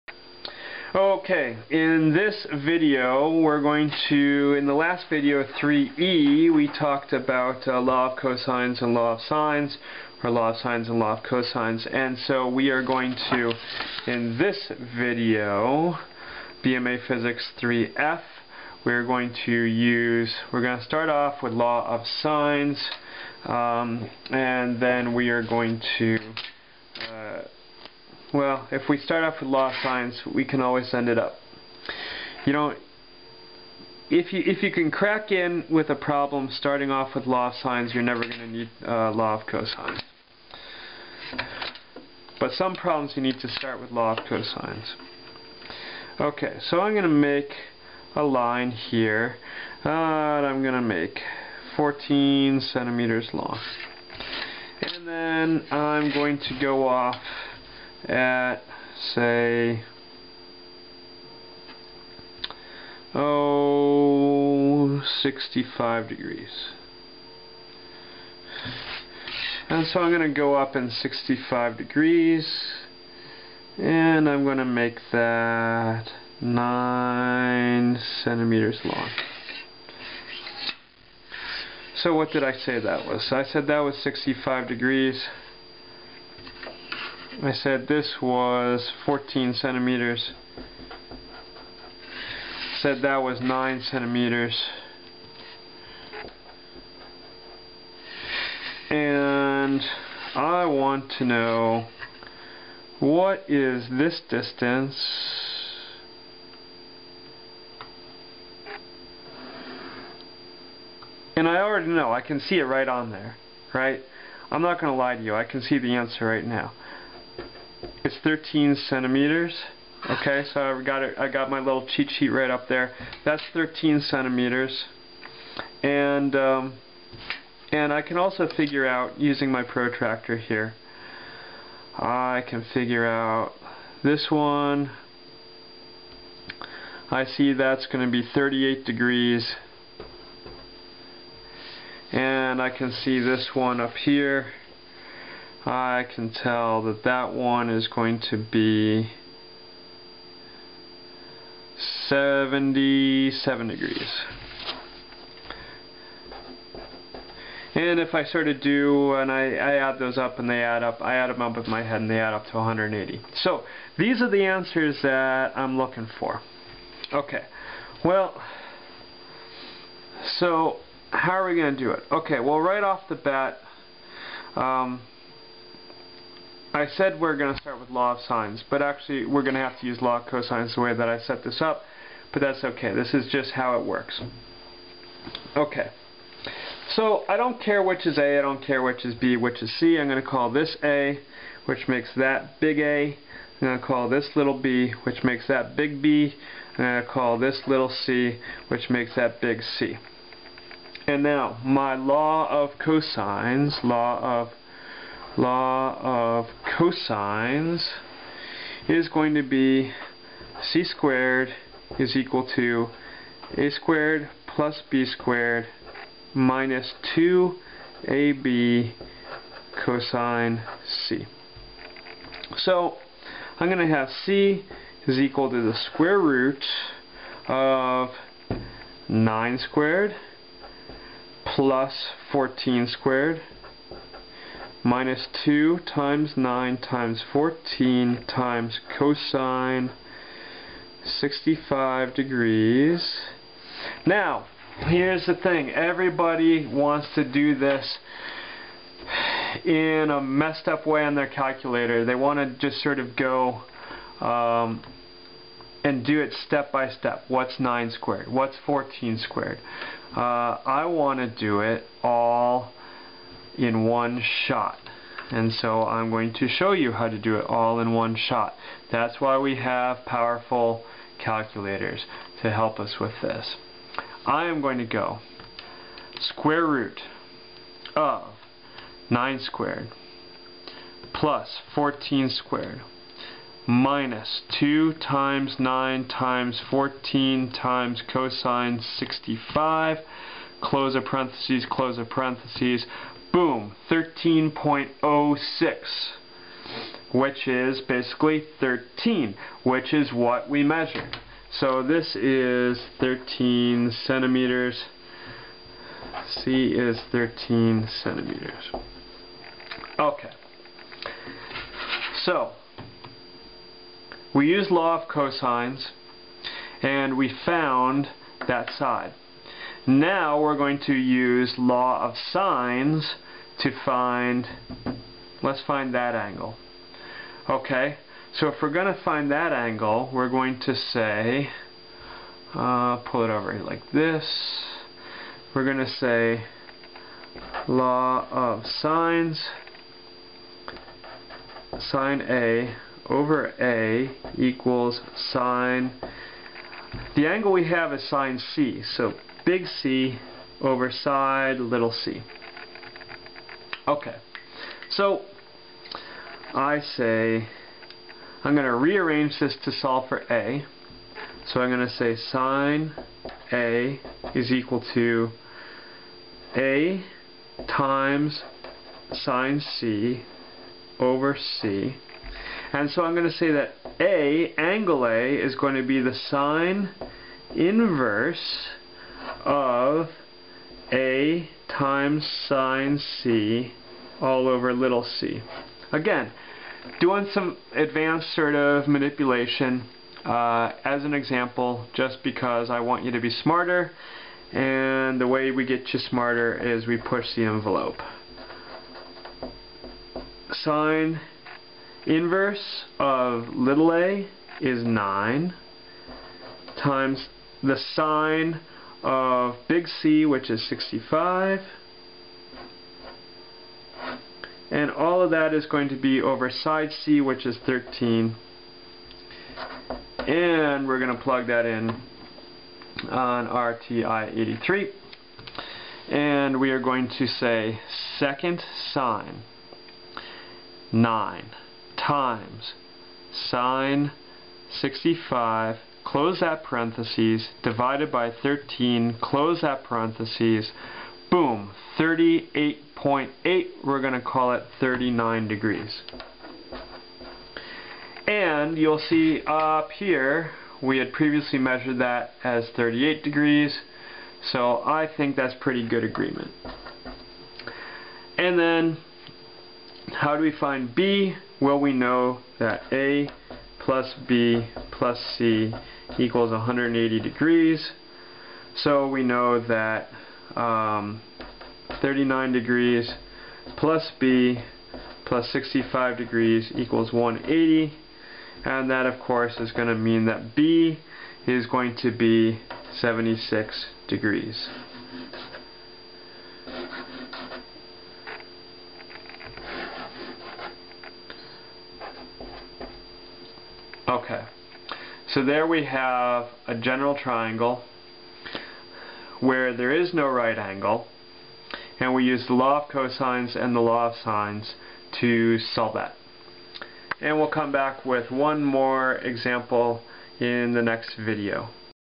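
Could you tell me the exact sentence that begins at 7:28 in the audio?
And you'll see up here, we had previously measured that as 38 degrees, so I think that's pretty good agreement.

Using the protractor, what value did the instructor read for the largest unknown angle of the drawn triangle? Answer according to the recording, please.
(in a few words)
77 degrees.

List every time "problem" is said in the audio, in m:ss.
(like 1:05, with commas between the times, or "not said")
0:35, 0:42.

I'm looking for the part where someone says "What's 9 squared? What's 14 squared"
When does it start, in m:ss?
4:17.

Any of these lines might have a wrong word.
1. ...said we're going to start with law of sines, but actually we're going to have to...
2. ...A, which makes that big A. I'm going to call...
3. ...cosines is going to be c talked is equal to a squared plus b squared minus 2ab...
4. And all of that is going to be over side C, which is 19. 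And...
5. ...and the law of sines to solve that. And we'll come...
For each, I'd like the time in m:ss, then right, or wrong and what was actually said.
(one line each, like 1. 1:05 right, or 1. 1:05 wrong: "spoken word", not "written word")
1. 2:56 right
2. 3:10 right
3. 3:26 wrong: "squared", not "talked"
4. 6:54 wrong: "13", not "19"
5. 8:23 right.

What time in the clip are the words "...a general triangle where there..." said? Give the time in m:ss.
8:16.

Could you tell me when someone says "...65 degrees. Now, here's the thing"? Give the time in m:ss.
4:01.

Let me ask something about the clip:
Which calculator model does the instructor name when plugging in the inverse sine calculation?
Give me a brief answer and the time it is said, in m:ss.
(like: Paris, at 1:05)
TI-83, at 7:03.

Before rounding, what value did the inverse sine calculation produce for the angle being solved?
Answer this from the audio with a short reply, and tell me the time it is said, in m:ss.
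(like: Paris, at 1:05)
38.8, at 7:21.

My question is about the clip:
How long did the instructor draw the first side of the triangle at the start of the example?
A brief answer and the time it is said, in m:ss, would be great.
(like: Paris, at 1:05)
14 centimeters, at 0:51.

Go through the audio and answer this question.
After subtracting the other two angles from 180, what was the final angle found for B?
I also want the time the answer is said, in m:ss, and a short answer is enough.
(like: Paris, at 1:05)
76 degrees, at 8:02.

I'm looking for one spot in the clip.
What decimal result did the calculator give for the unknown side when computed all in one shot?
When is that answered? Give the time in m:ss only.
4:53.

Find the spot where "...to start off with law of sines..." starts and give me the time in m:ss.
0:20.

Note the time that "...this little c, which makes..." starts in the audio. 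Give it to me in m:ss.
3:17.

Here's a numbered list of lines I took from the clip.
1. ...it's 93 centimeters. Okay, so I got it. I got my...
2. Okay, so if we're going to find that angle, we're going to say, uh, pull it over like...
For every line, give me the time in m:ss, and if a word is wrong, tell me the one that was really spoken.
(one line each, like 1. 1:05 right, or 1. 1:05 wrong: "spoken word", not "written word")
1. 1:58 wrong: "13", not "93"
2. 5:27 right.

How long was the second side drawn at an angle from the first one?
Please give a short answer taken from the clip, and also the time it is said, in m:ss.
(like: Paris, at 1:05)
9 centimeters, at 1:16.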